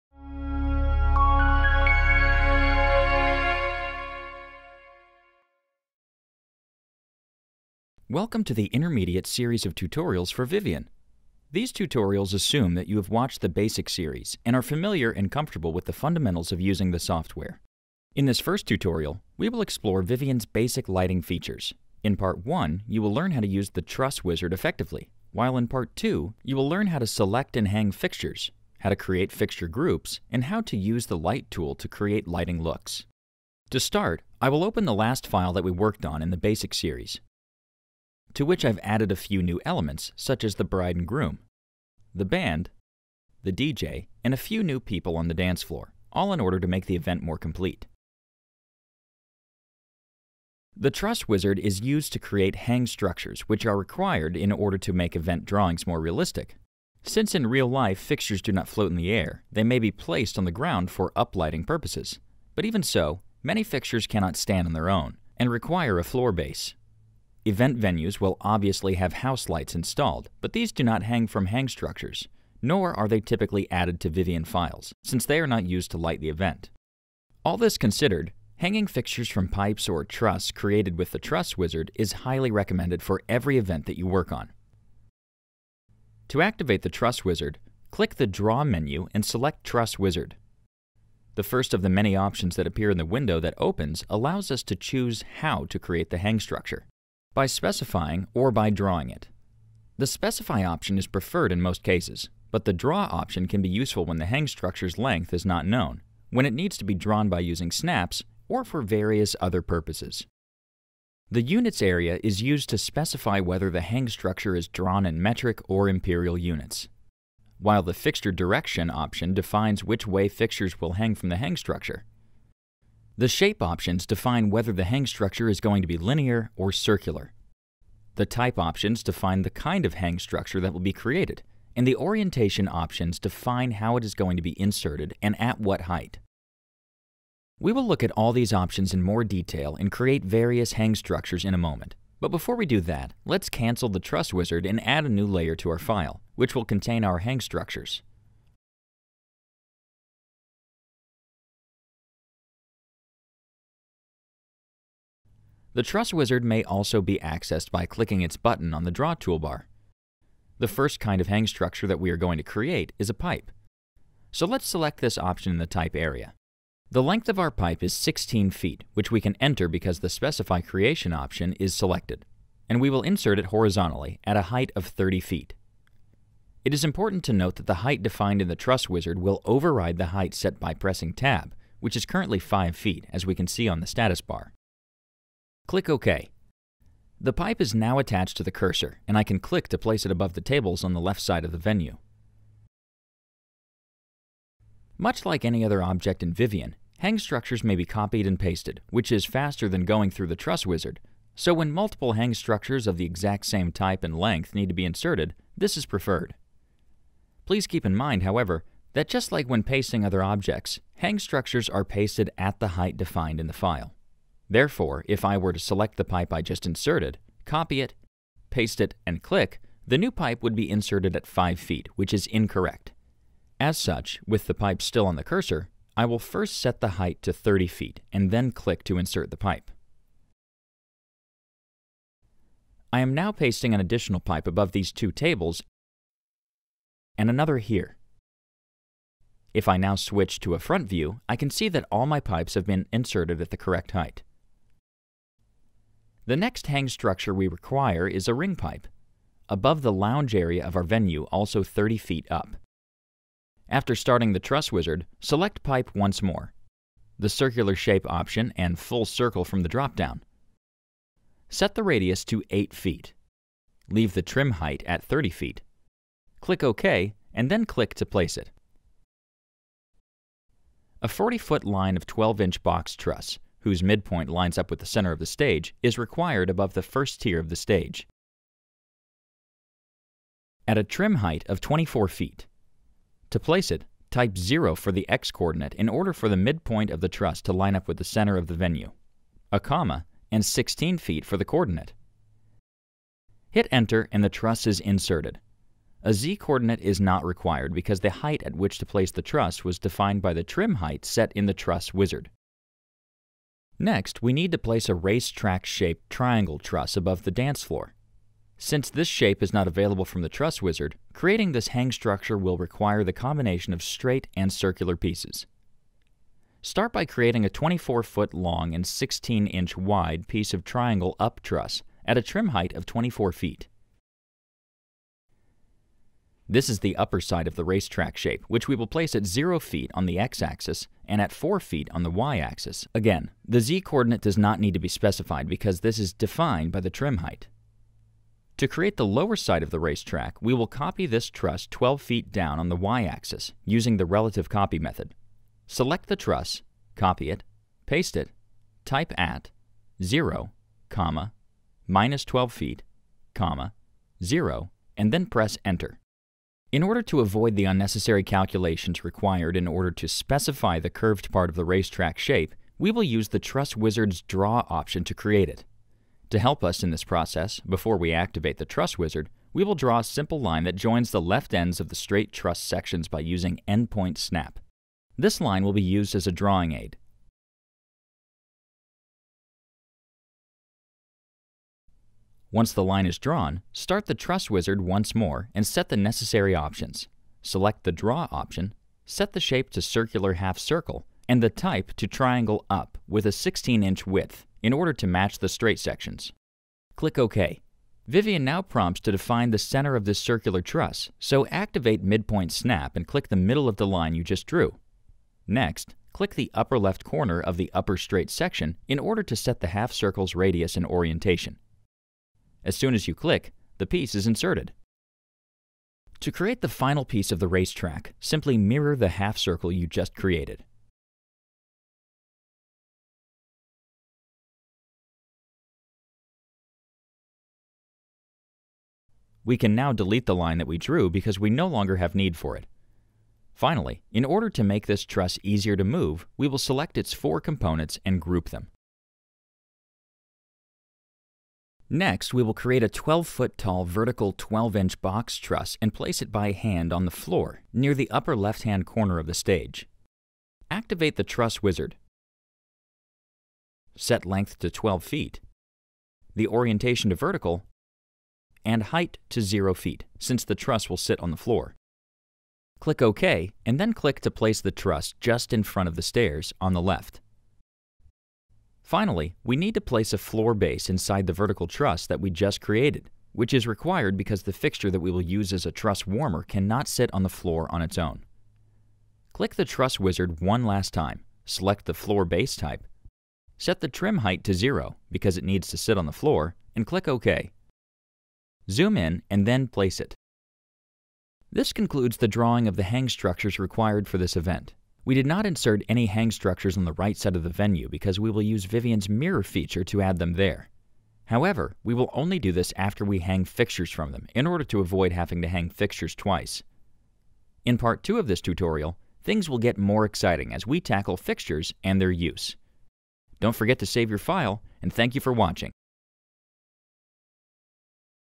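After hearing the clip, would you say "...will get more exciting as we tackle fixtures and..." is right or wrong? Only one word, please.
right.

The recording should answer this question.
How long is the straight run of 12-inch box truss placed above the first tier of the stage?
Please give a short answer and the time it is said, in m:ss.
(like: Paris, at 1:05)
40 feet, at 4:31.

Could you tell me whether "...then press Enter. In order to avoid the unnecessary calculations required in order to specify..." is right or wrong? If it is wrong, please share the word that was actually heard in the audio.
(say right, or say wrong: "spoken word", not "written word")
right.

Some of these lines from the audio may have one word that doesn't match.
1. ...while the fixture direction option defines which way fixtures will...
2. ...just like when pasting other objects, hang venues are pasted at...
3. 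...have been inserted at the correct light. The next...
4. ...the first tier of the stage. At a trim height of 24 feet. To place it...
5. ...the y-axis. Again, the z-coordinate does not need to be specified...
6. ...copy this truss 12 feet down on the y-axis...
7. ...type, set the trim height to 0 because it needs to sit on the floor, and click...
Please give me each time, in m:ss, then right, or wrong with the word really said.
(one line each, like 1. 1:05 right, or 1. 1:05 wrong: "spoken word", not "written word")
1. 1:57 right
2. 3:29 wrong: "structures", not "venues"
3. 4:02 wrong: "height", not "light"
4. 4:36 right
5. 5:32 right
6. 5:40 right
7. 8:02 right.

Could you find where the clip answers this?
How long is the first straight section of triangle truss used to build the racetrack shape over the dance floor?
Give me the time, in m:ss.
5:17.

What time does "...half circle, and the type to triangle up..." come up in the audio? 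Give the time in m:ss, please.
6:30.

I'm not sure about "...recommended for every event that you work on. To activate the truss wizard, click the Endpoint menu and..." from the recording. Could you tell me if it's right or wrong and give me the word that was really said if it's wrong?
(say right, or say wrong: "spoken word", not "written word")
wrong: "Draw", not "Endpoint".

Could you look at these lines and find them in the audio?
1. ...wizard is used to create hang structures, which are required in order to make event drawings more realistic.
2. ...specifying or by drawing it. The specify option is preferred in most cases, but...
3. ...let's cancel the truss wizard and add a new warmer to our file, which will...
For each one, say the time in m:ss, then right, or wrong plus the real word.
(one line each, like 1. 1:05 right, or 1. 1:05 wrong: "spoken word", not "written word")
1. 0:51 right
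2. 1:37 right
3. 2:23 wrong: "layer", not "warmer".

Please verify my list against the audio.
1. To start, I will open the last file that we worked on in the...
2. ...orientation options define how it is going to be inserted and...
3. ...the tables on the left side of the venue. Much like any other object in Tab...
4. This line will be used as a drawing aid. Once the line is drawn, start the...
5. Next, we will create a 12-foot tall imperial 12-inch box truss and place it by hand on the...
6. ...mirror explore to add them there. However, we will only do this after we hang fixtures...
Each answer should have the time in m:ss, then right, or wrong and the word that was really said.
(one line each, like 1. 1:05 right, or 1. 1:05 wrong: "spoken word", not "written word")
1. 0:33 right
2. 2:11 right
3. 3:10 wrong: "Vivien", not "Tab"
4. 6:15 right
5. 7:21 wrong: "vertical", not "imperial"
6. 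8:19 wrong: "feature", not "explore".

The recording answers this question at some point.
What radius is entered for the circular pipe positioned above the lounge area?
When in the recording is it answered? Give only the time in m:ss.
4:22.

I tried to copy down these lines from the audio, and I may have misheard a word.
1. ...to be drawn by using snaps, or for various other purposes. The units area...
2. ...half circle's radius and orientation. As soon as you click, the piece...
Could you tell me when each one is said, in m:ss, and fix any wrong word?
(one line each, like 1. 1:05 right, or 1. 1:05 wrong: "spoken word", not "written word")
1. 1:46 right
2. 6:49 right.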